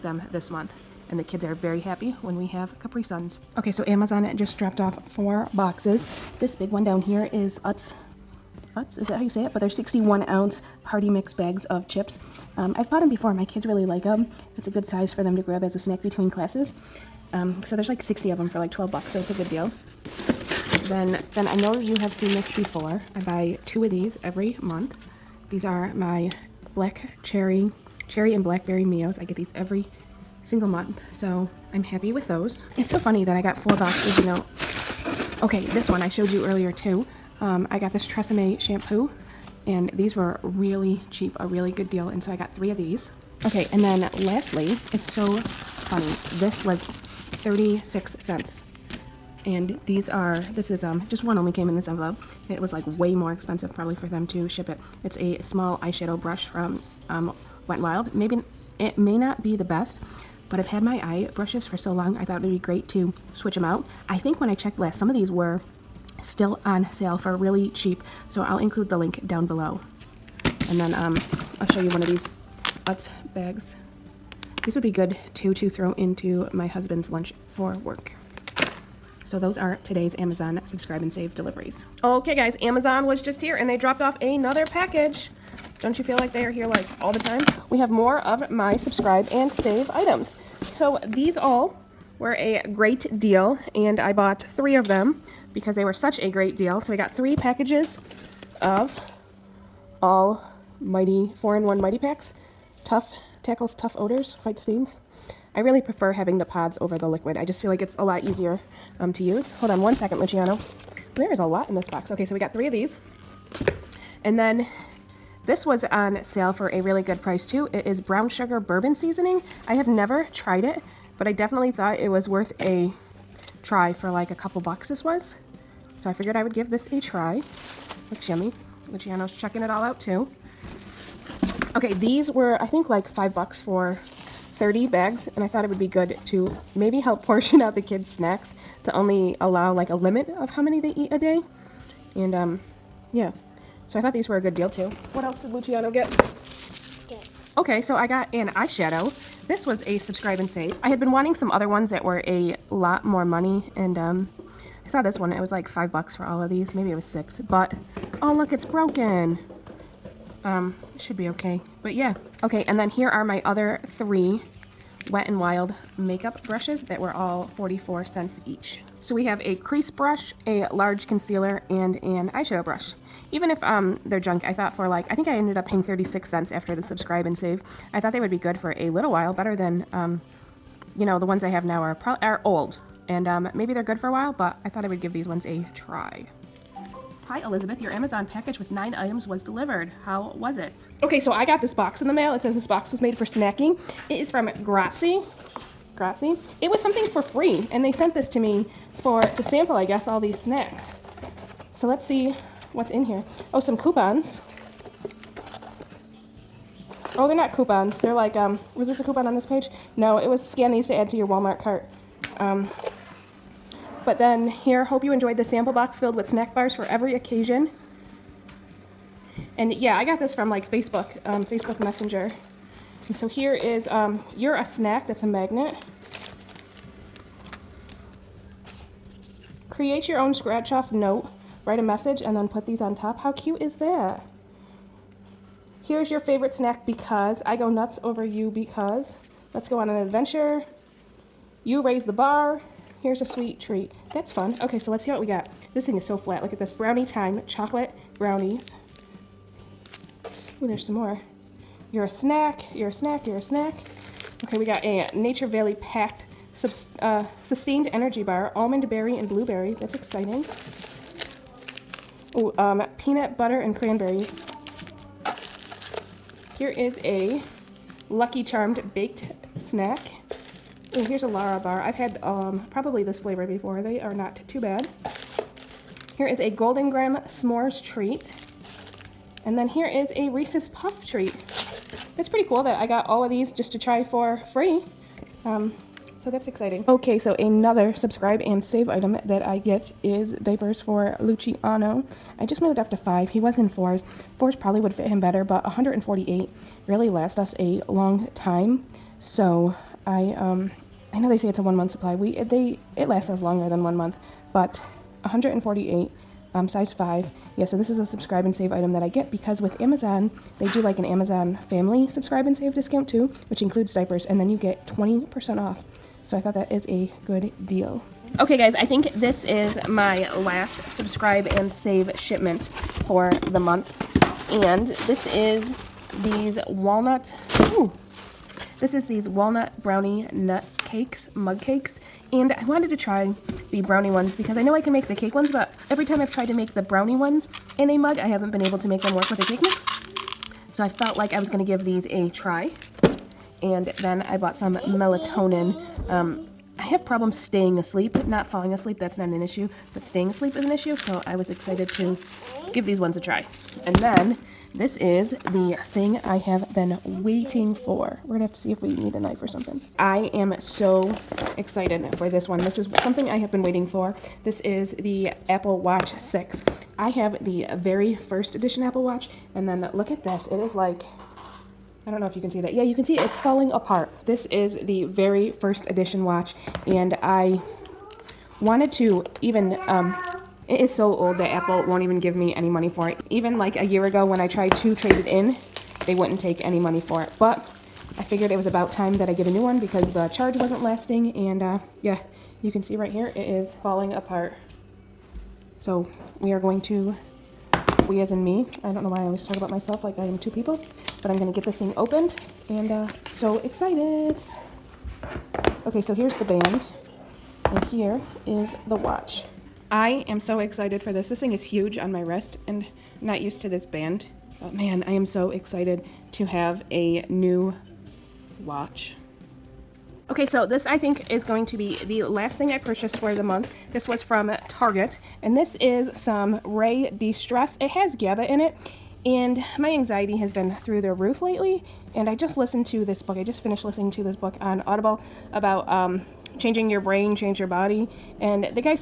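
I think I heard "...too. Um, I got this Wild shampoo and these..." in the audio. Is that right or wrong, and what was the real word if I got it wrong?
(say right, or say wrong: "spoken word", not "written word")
wrong: "Tresemme", not "Wild".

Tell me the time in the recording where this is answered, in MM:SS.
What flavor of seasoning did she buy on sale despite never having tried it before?
01:57.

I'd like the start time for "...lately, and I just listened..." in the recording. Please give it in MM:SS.
07:11.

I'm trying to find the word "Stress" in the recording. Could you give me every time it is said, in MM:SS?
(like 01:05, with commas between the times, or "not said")
07:07.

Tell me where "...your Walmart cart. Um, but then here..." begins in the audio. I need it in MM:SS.
03:31.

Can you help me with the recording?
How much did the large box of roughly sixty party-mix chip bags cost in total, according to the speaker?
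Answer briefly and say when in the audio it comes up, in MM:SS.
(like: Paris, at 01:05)
$12, at 00:18.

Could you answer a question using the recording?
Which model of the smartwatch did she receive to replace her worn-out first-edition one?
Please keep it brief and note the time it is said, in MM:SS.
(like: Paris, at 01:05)
Apple Watch 6, at 06:05.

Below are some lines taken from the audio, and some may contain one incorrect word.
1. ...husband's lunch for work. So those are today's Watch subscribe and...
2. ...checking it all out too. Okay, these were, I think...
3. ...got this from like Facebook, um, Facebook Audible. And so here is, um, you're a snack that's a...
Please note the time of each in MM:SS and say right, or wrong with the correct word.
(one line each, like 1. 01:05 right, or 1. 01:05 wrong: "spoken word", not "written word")
1. 01:16 wrong: "Amazon", not "Watch"
2. 02:09 right
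3. 03:40 wrong: "Messenger", not "Audible".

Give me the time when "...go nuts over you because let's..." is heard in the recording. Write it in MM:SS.
03:57.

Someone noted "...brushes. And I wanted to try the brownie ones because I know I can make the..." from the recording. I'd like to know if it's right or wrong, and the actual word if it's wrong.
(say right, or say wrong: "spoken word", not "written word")
wrong: "cakes", not "brushes".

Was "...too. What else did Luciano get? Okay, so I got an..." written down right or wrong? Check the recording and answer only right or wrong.
right.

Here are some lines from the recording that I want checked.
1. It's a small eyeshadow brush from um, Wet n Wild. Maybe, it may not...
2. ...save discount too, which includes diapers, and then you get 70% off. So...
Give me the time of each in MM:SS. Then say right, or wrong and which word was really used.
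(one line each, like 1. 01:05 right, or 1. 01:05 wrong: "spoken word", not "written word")
1. 00:55 right
2. 05:12 wrong: "20", not "70".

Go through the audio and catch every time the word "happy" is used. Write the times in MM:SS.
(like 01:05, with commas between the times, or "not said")
00:01, 00:31.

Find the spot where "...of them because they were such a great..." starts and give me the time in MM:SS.
01:34.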